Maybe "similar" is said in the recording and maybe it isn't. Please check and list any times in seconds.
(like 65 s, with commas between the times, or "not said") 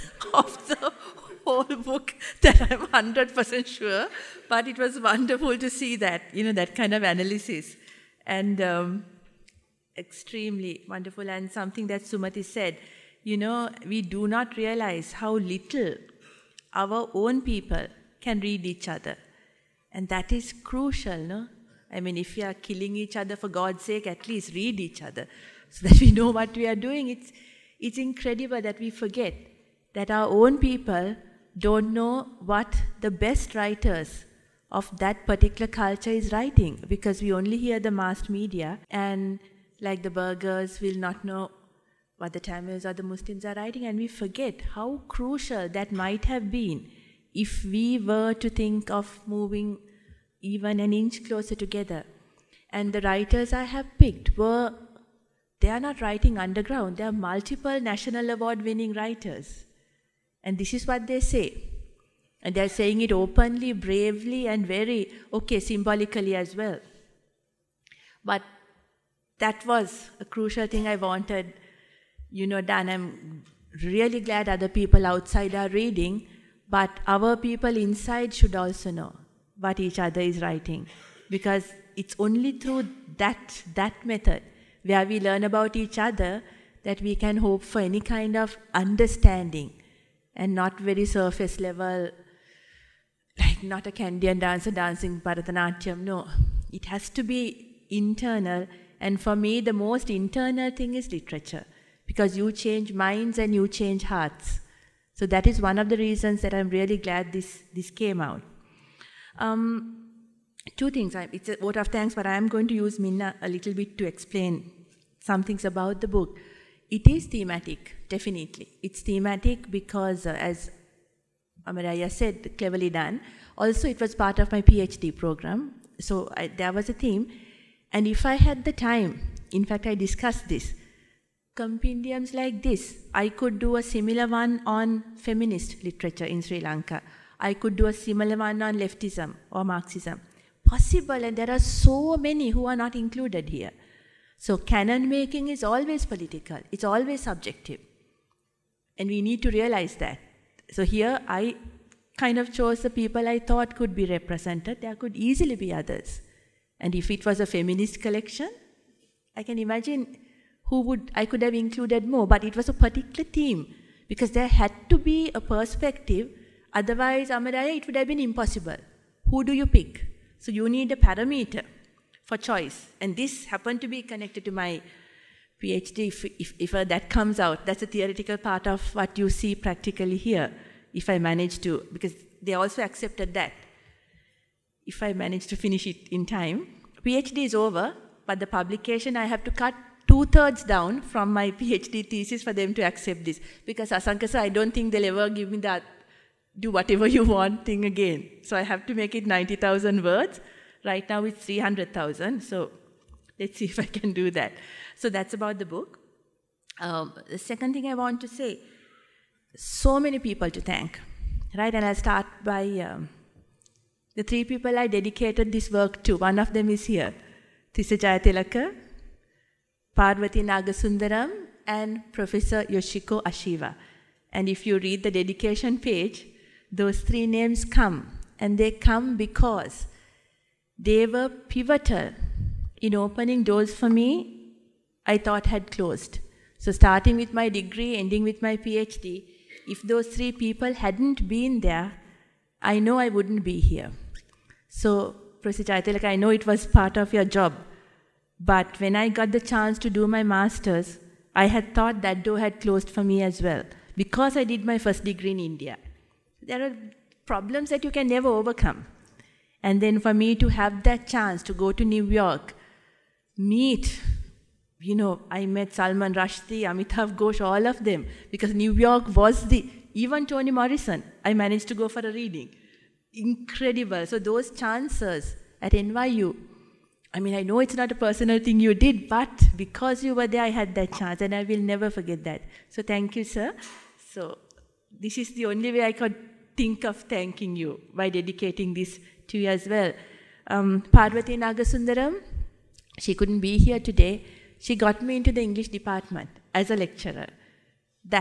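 133 s, 137 s.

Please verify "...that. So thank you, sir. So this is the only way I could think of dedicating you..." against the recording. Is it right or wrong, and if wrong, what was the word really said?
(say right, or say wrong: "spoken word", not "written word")
wrong: "thanking", not "dedicating".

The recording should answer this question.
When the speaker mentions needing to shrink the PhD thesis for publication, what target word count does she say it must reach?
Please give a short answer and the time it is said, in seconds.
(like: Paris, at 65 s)
90,000 words, at 199 s.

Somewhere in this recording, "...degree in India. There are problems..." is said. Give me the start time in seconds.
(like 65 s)
255 s.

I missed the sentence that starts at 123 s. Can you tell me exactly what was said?
Also, it was part of my PhD program, so I, there was a theme.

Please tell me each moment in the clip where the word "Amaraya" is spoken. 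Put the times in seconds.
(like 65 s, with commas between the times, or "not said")
121 s, 167 s.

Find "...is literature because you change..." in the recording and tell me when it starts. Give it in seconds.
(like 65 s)
100 s.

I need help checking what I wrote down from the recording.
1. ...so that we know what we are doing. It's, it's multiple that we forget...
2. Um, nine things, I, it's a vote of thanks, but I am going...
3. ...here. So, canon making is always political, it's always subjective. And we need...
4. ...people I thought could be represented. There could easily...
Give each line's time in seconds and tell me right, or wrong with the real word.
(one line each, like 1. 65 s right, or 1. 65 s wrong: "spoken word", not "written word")
1. 25 s wrong: "incredible", not "multiple"
2. 109 s wrong: "two", not "nine"
3. 143 s right
4. 152 s right.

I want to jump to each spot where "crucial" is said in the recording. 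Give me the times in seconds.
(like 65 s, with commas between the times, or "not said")
20 s, 45 s, 70 s.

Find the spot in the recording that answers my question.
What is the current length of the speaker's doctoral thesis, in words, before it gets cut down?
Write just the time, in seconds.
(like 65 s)
201 s.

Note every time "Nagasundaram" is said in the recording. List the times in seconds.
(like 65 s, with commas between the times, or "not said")
220 s, 291 s.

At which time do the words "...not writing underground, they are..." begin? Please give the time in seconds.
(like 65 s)
55 s.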